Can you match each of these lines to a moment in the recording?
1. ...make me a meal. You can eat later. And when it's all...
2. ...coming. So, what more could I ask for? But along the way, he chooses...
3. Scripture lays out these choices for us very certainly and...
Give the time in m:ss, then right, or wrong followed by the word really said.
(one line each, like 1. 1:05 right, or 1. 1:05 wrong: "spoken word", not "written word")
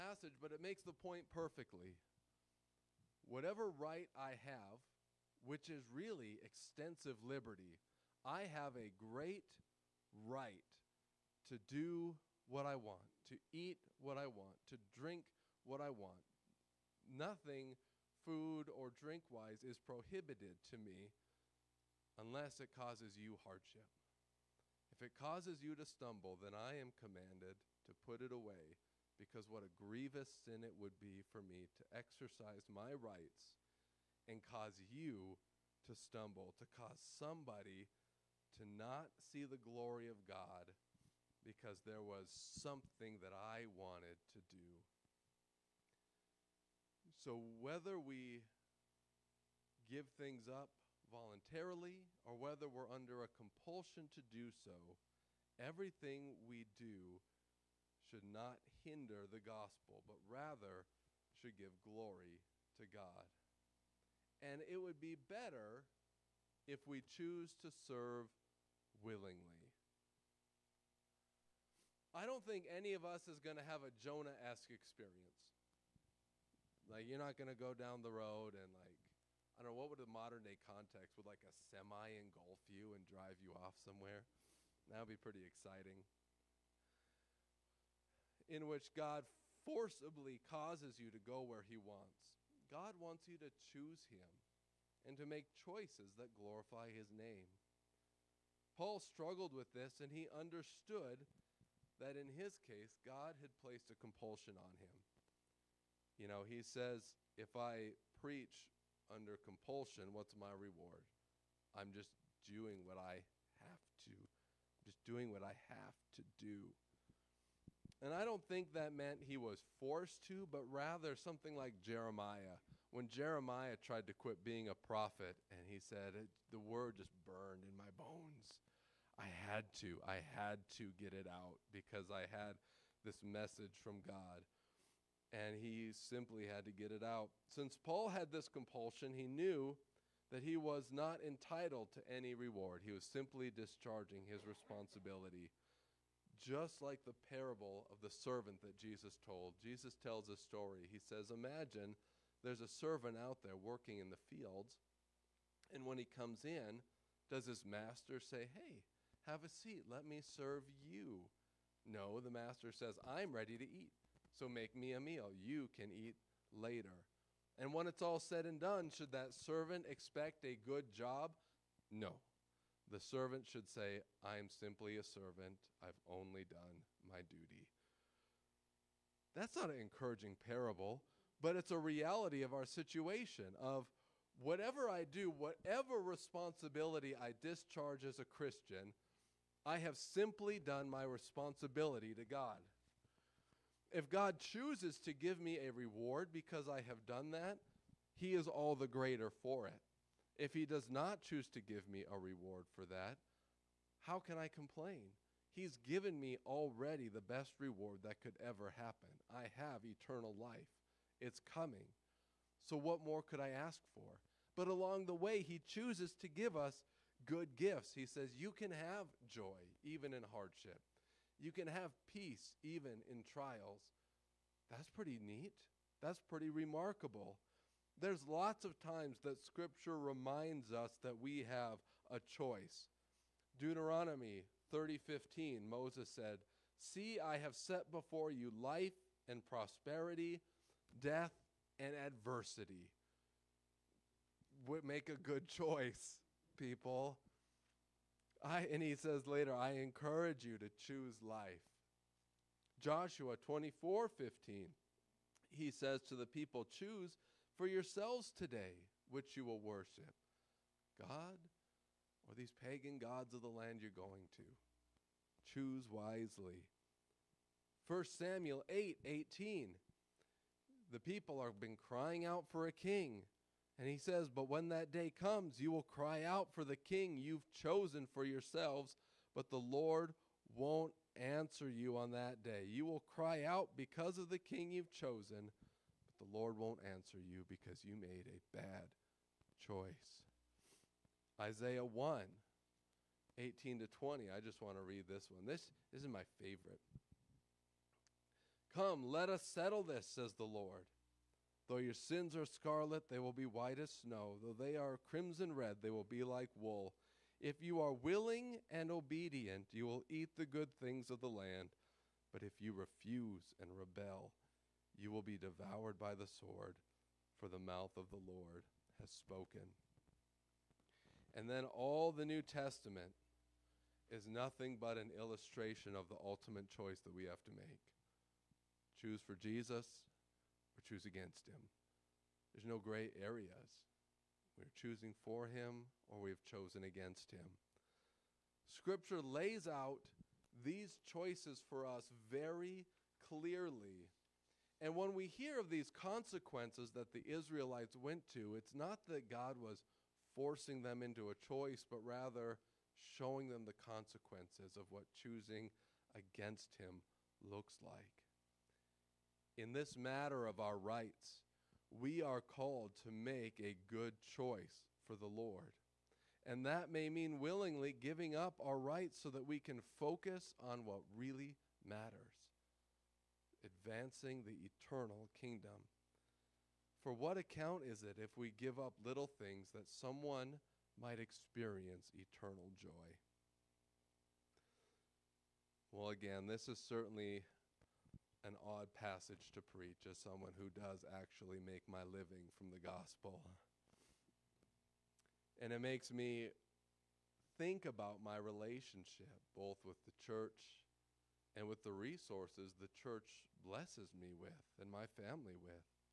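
1. 2:44 right
2. 3:31 right
3. 5:38 wrong: "clearly", not "certainly".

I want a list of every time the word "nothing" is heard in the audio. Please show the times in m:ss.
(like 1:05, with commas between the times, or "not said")
0:17, 5:24.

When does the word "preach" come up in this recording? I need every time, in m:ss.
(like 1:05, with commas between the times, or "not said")
1:48, 6:29.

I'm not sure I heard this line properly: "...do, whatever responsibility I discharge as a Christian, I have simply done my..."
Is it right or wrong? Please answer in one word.
right.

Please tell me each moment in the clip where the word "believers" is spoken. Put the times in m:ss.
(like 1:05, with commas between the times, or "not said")
not said.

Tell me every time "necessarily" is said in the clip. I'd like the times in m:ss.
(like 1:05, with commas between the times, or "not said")
not said.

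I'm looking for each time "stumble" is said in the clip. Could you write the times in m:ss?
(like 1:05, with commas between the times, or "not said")
0:25, 0:35.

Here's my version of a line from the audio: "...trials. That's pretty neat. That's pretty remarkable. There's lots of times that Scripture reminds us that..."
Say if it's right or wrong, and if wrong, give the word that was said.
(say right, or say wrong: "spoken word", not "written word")
right.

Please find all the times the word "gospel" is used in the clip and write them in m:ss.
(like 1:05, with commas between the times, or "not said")
0:59, 6:32.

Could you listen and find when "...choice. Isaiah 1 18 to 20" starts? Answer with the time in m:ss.
4:49.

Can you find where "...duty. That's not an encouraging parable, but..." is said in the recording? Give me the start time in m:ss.
2:57.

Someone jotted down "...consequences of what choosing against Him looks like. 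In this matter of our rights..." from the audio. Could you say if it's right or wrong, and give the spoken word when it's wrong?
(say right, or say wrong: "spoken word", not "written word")
right.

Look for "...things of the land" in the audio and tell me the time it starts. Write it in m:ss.
5:10.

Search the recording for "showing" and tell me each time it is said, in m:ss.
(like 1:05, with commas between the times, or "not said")
5:53.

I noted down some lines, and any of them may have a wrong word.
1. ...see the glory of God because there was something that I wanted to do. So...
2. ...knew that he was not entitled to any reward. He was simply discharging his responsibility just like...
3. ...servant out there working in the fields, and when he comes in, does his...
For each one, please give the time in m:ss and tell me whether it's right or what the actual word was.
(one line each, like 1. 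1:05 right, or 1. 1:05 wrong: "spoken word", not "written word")
1. 0:39 right
2. 2:19 right
3. 2:32 right.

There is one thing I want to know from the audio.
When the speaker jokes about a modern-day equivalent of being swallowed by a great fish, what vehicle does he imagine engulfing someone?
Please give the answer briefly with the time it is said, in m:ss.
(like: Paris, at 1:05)
A semi, at 1:21.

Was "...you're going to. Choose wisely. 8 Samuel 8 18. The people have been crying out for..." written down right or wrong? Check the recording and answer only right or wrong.
wrong.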